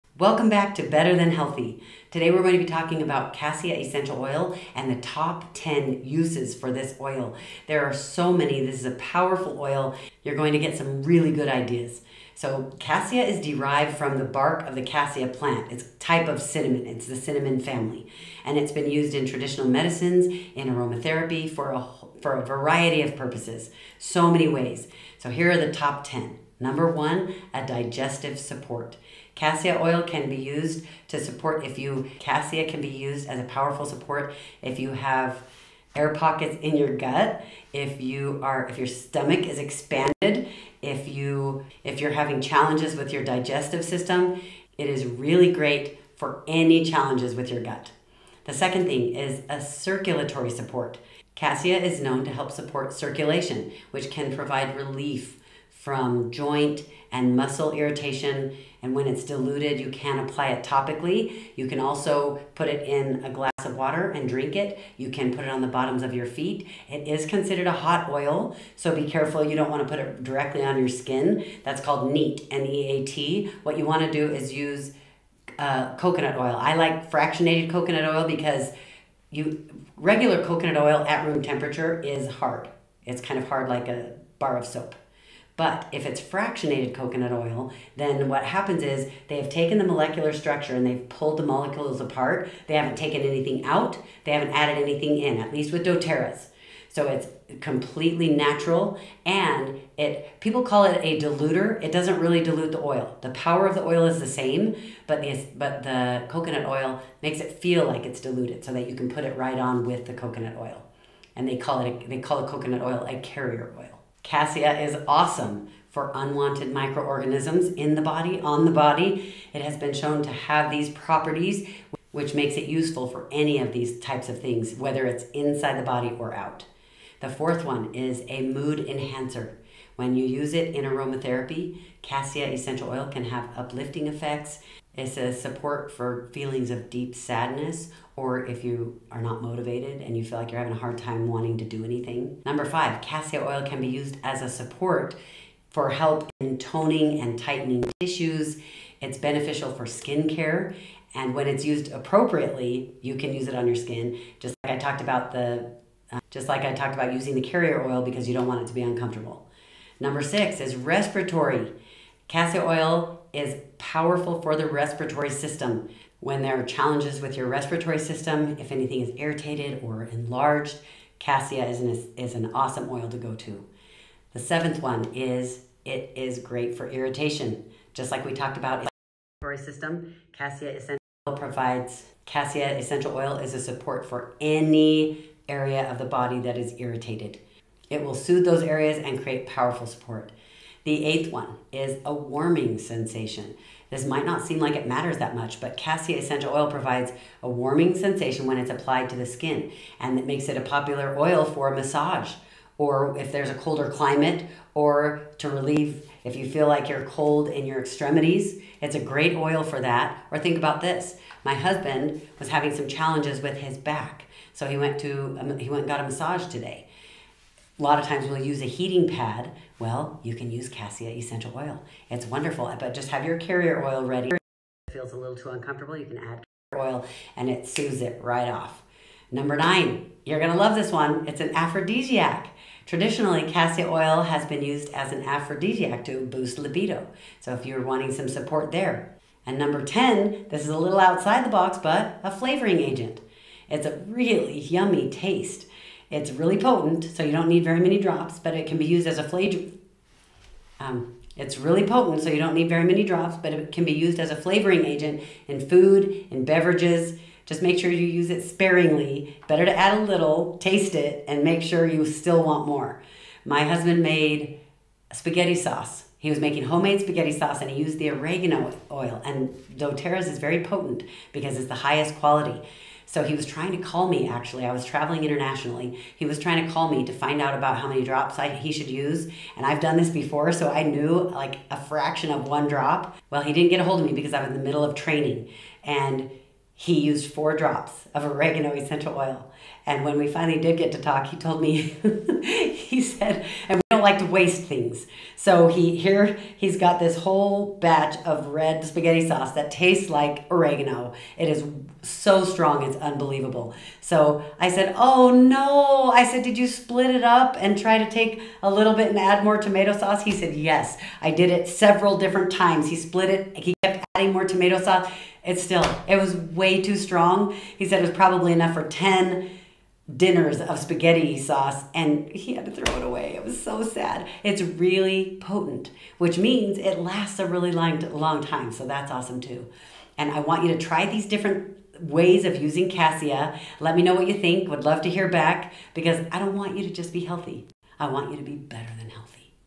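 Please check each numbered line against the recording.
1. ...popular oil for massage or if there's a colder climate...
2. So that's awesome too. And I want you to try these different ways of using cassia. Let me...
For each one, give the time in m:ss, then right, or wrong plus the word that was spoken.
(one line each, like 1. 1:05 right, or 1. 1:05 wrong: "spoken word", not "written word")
1. 3:20 right
2. 5:28 right.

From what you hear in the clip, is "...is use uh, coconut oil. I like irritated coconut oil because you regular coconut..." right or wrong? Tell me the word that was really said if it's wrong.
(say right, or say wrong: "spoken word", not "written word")
wrong: "fractionated", not "irritated".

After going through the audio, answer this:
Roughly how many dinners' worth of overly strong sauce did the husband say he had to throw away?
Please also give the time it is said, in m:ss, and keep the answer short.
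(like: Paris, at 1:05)
10, at 5:18.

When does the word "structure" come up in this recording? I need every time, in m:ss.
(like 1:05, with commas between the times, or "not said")
1:30.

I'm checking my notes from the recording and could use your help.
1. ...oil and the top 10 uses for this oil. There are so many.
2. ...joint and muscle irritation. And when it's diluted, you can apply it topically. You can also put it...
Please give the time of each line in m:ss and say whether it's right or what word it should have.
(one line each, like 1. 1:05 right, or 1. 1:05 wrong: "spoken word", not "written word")
1. 0:04 right
2. 0:56 right.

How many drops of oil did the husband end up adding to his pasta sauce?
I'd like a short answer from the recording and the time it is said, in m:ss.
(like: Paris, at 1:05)
4, at 4:47.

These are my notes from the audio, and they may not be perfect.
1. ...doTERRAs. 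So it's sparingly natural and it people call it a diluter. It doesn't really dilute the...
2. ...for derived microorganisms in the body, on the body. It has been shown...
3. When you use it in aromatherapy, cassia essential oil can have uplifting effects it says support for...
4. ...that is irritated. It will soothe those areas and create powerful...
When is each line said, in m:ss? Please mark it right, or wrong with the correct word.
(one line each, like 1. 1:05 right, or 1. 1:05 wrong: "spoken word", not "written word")
1. 1:35 wrong: "completely", not "sparingly"
2. 1:55 wrong: "unwanted", not "derived"
3. 2:09 right
4. 3:06 right.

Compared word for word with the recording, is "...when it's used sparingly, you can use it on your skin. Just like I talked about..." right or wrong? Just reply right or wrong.
wrong.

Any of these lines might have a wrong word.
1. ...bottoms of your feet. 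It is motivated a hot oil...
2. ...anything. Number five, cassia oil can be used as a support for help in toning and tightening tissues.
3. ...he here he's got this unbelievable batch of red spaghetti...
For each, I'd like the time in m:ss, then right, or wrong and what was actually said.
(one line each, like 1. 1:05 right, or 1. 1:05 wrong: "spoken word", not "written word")
1. 1:05 wrong: "considered", not "motivated"
2. 2:21 right
3. 4:55 wrong: "whole", not "unbelievable".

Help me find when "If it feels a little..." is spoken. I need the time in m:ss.
3:44.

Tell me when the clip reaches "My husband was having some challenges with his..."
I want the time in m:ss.
3:31.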